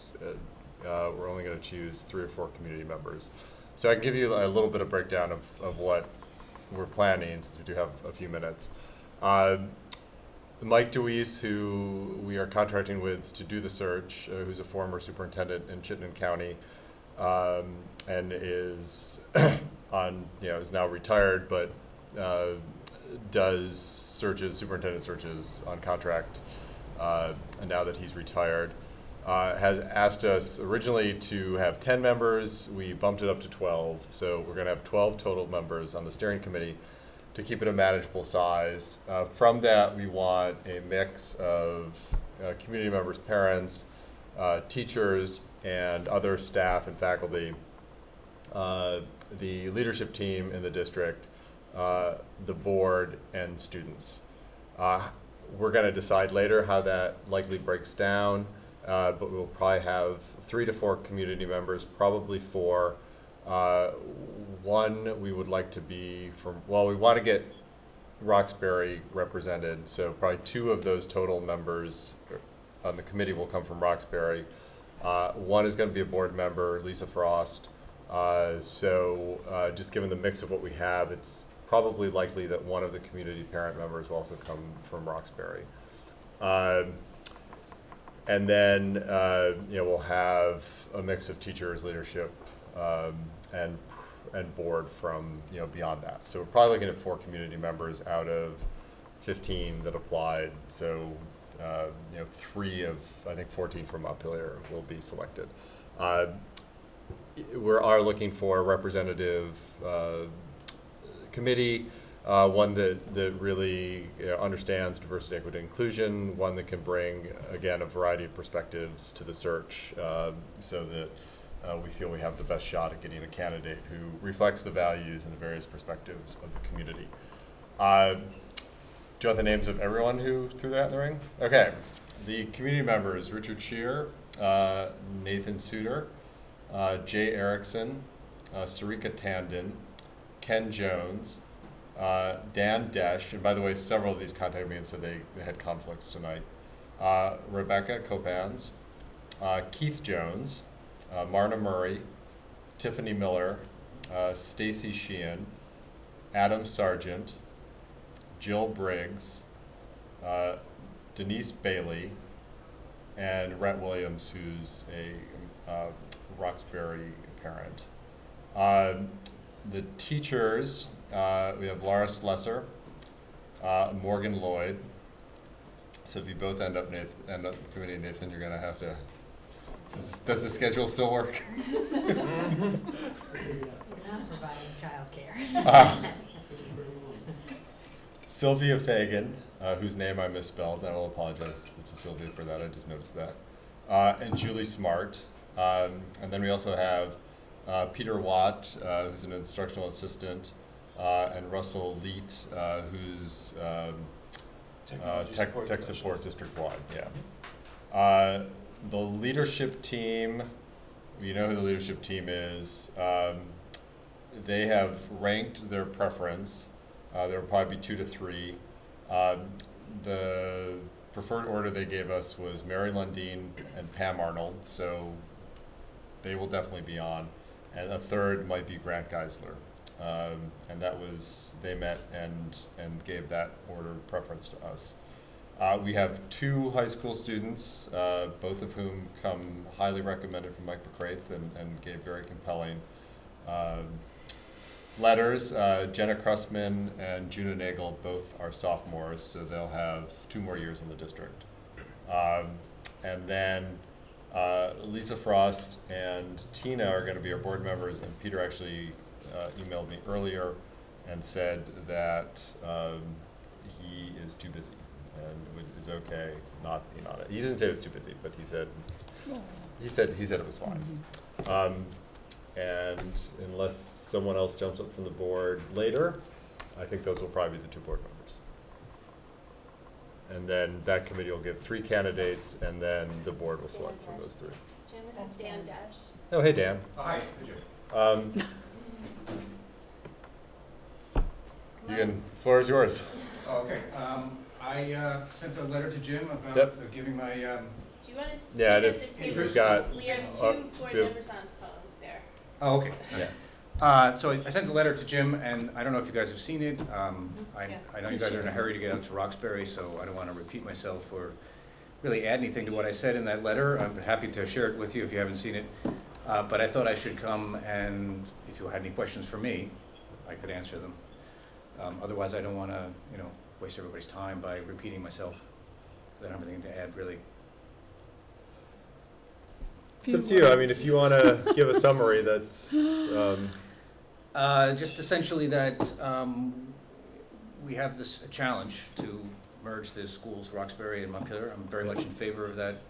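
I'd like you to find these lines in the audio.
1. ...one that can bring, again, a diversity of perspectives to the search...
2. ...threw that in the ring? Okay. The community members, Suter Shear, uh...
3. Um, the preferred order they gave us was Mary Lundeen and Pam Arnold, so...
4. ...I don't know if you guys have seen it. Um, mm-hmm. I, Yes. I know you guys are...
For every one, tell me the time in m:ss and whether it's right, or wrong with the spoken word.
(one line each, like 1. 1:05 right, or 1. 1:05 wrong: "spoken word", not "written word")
1. 1:56 wrong: "variety", not "diversity"
2. 2:10 wrong: "Richard", not "Suter"
3. 3:39 right
4. 5:05 right.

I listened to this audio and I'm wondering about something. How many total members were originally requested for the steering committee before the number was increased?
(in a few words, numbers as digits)
10.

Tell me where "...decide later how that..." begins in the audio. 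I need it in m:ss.
0:55.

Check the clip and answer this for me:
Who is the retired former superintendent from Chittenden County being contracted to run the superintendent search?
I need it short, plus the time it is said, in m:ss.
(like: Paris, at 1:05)
Mike Deweese, at 0:10.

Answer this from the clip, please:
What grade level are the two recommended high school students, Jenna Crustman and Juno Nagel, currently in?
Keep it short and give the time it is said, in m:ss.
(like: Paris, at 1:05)
sophomores, at 4:08.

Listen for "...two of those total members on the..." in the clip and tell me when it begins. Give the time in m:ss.
1:10.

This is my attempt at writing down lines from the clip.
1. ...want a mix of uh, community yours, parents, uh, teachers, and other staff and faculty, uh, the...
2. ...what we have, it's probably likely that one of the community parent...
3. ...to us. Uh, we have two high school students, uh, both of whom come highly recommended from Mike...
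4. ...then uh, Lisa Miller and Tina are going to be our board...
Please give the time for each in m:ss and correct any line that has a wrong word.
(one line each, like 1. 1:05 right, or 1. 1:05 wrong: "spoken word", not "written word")
1. 0:40 wrong: "members", not "yours"
2. 1:20 right
3. 3:54 right
4. 4:13 wrong: "Frost", not "Miller".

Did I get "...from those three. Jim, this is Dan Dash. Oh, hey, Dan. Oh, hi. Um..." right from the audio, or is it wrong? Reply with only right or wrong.
right.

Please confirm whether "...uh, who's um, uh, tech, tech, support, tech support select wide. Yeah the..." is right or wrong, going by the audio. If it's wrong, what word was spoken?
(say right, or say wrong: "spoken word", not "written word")
wrong: "district", not "select".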